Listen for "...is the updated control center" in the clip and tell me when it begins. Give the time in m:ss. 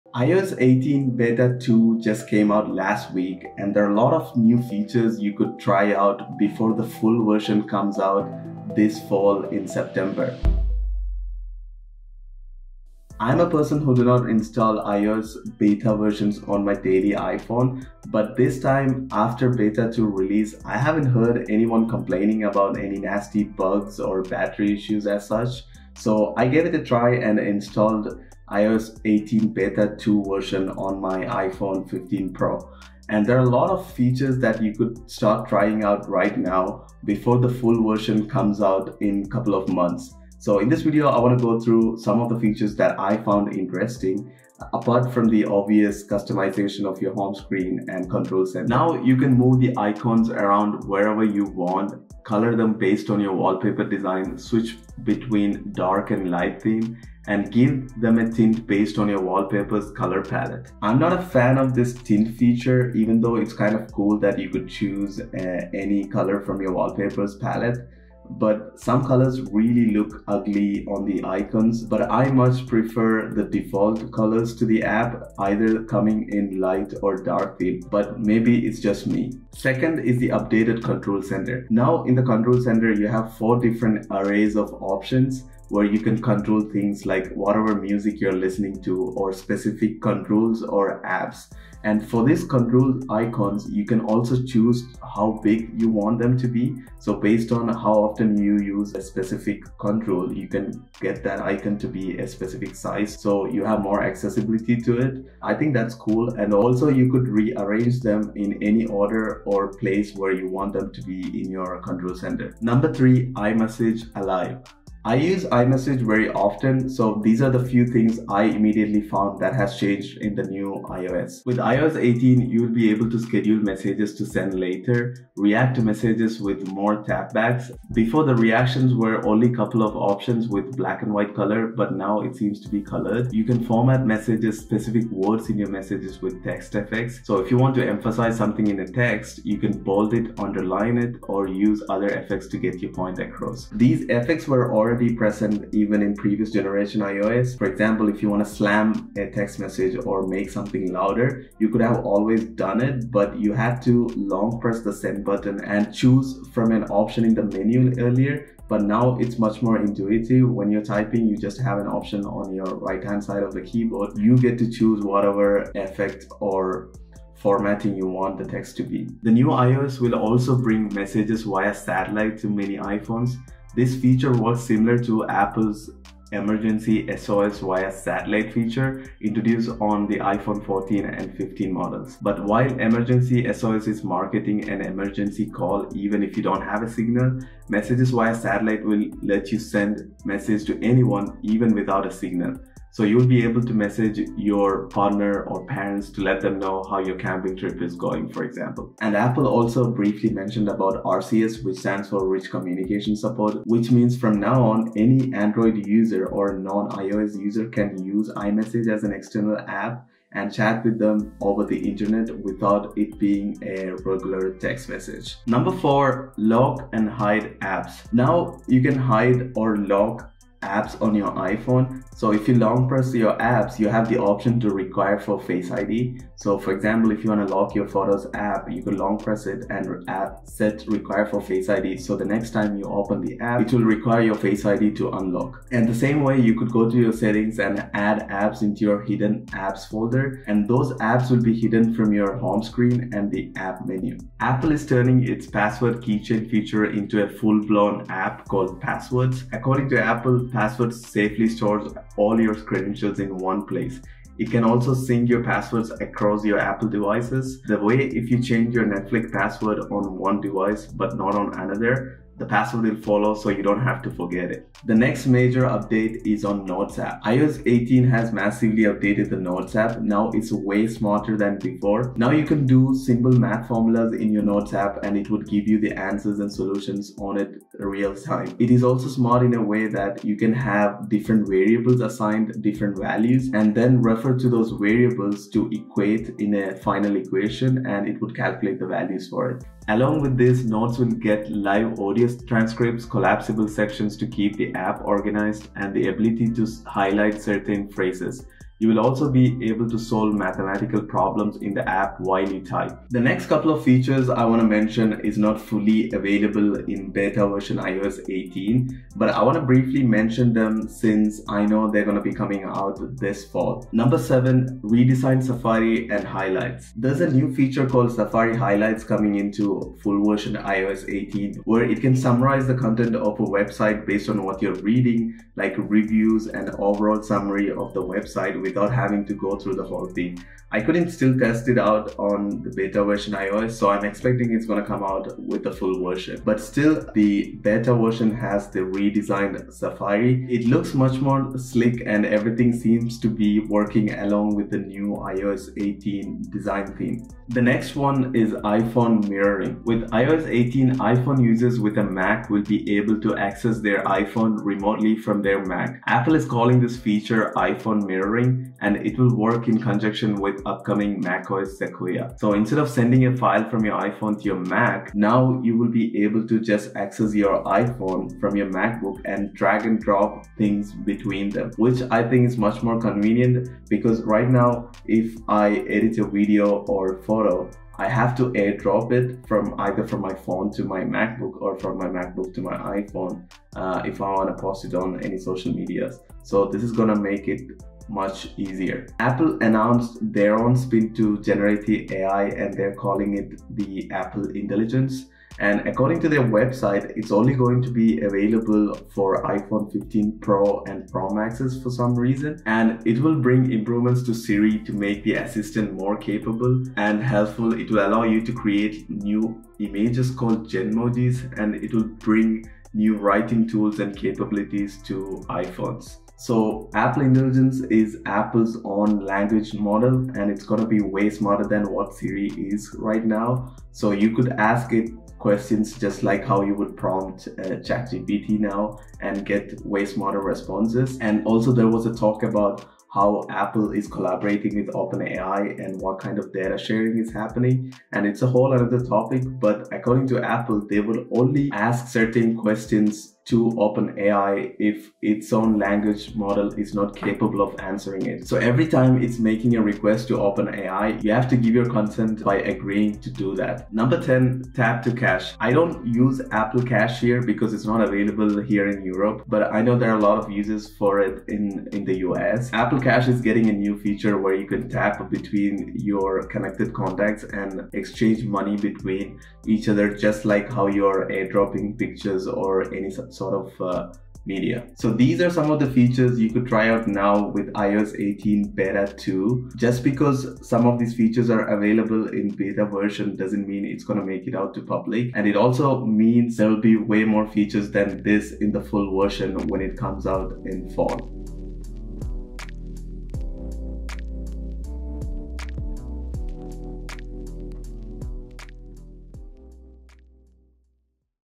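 1:19.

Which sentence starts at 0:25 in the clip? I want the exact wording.
So I gave it a try and installed iOS 18 beta 2 version on my iPhone 15 Pro.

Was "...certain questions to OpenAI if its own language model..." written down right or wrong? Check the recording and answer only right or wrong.
right.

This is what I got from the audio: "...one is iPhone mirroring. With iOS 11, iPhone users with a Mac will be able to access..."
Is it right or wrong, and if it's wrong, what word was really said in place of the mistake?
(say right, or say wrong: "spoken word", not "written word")
wrong: "18", not "11".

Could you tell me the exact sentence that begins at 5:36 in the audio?
But still, the beta version has the redesigned Safari.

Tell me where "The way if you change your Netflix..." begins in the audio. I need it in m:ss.
4:17.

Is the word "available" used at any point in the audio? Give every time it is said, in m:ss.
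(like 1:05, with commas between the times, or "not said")
5:06, 6:38, 7:38, 8:01.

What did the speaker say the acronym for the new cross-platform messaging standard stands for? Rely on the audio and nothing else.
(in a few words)
Rich Communication Support.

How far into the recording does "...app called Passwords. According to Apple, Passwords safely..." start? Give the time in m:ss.
4:08.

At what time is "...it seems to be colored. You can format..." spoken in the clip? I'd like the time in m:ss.
2:12.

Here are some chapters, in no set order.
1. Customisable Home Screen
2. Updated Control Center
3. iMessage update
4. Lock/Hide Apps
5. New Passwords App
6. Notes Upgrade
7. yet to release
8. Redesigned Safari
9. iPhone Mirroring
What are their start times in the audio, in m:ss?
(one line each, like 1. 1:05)
1. 0:55
2. 1:52
3. 2:02
4. 3:40
5. 4:06
6. 4:25
7. 5:04
8. 5:16
9. 5:48.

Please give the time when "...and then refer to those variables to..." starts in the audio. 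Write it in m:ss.
4:43.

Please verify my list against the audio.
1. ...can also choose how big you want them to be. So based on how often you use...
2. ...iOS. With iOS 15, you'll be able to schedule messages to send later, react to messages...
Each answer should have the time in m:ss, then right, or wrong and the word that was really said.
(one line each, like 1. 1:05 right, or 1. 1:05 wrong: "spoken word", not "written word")
1. 1:33 right
2. 2:00 wrong: "18", not "15".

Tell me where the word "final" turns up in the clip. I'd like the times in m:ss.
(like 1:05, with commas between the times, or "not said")
4:46.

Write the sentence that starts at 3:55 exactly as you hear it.
And the same way, you could go to your settings and add apps into your hidden apps folder.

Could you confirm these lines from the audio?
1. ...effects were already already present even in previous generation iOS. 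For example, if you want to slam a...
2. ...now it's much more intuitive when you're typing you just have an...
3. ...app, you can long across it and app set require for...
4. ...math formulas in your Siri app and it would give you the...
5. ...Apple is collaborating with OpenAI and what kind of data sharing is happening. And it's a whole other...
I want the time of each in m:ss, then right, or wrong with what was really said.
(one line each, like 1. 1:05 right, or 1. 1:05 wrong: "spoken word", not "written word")
1. 2:24 right
2. 2:38 right
3. 3:48 wrong: "press", not "across"
4. 4:33 wrong: "Notes", not "Siri"
5. 7:13 right.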